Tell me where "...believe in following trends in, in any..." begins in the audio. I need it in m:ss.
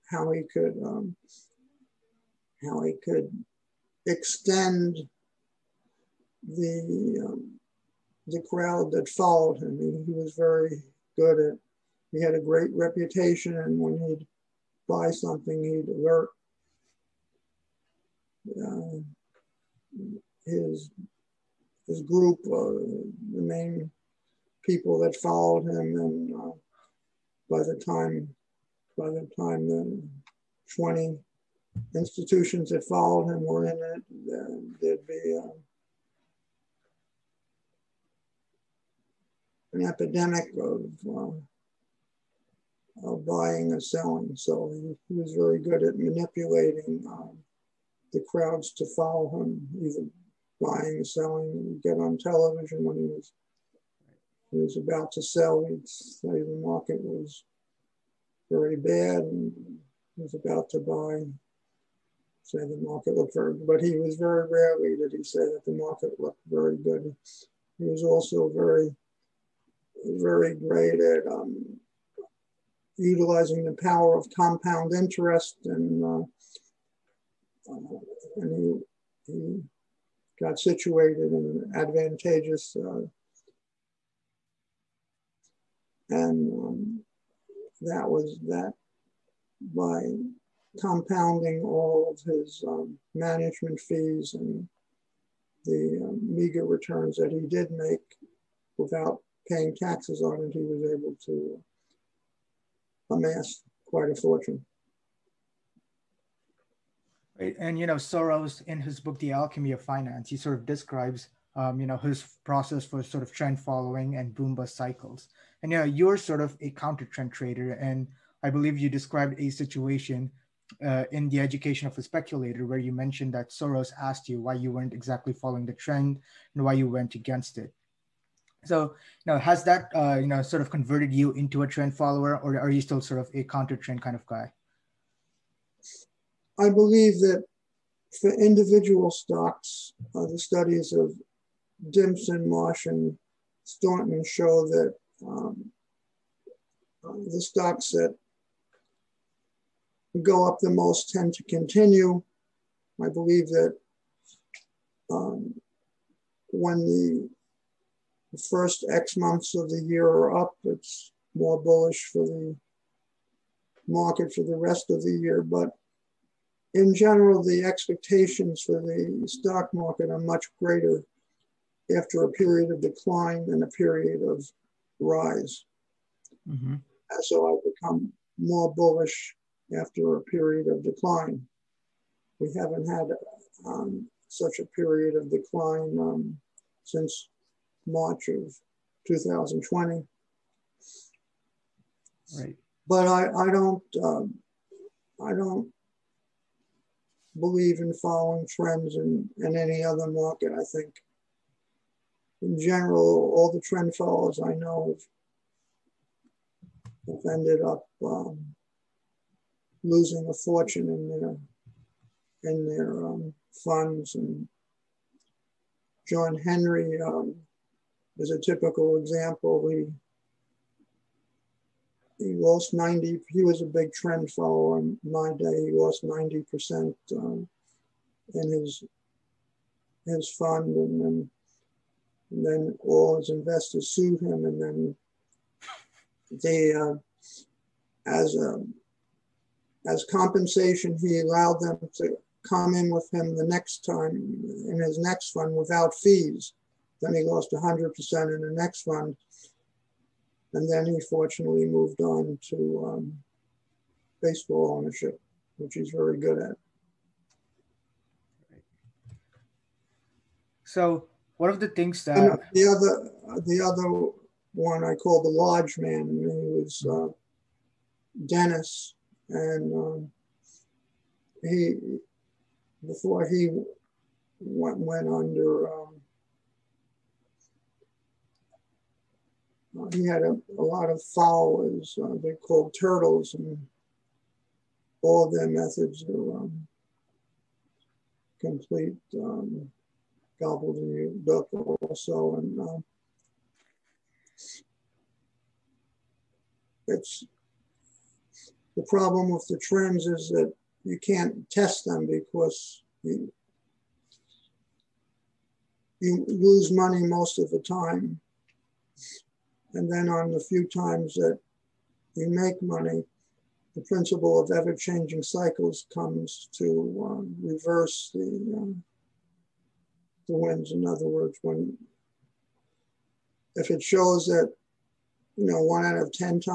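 3:17.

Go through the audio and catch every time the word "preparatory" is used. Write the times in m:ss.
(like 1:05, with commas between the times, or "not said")
not said.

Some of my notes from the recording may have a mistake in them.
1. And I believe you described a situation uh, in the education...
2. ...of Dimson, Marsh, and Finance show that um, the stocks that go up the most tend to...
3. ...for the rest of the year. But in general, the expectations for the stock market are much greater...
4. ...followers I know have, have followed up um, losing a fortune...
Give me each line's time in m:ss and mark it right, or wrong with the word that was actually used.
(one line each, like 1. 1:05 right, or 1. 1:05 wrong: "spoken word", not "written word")
1. 1:57 right
2. 2:20 wrong: "Staunton", not "Finance"
3. 2:44 right
4. 3:23 wrong: "ended", not "followed".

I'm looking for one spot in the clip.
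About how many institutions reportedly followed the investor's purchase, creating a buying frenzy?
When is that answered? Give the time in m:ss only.
0:30.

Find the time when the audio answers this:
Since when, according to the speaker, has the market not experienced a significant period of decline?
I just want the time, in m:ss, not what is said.
3:07.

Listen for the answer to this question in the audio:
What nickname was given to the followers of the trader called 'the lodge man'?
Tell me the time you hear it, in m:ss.
4:42.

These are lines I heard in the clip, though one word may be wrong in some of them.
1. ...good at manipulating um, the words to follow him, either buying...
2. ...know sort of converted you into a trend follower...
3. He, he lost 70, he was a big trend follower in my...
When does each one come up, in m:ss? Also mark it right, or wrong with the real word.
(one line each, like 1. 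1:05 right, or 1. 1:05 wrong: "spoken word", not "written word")
1. 0:45 wrong: "crowds", not "words"
2. 2:10 right
3. 3:39 wrong: "90", not "70".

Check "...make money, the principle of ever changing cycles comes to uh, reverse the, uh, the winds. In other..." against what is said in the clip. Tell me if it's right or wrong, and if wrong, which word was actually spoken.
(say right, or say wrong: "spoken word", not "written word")
right.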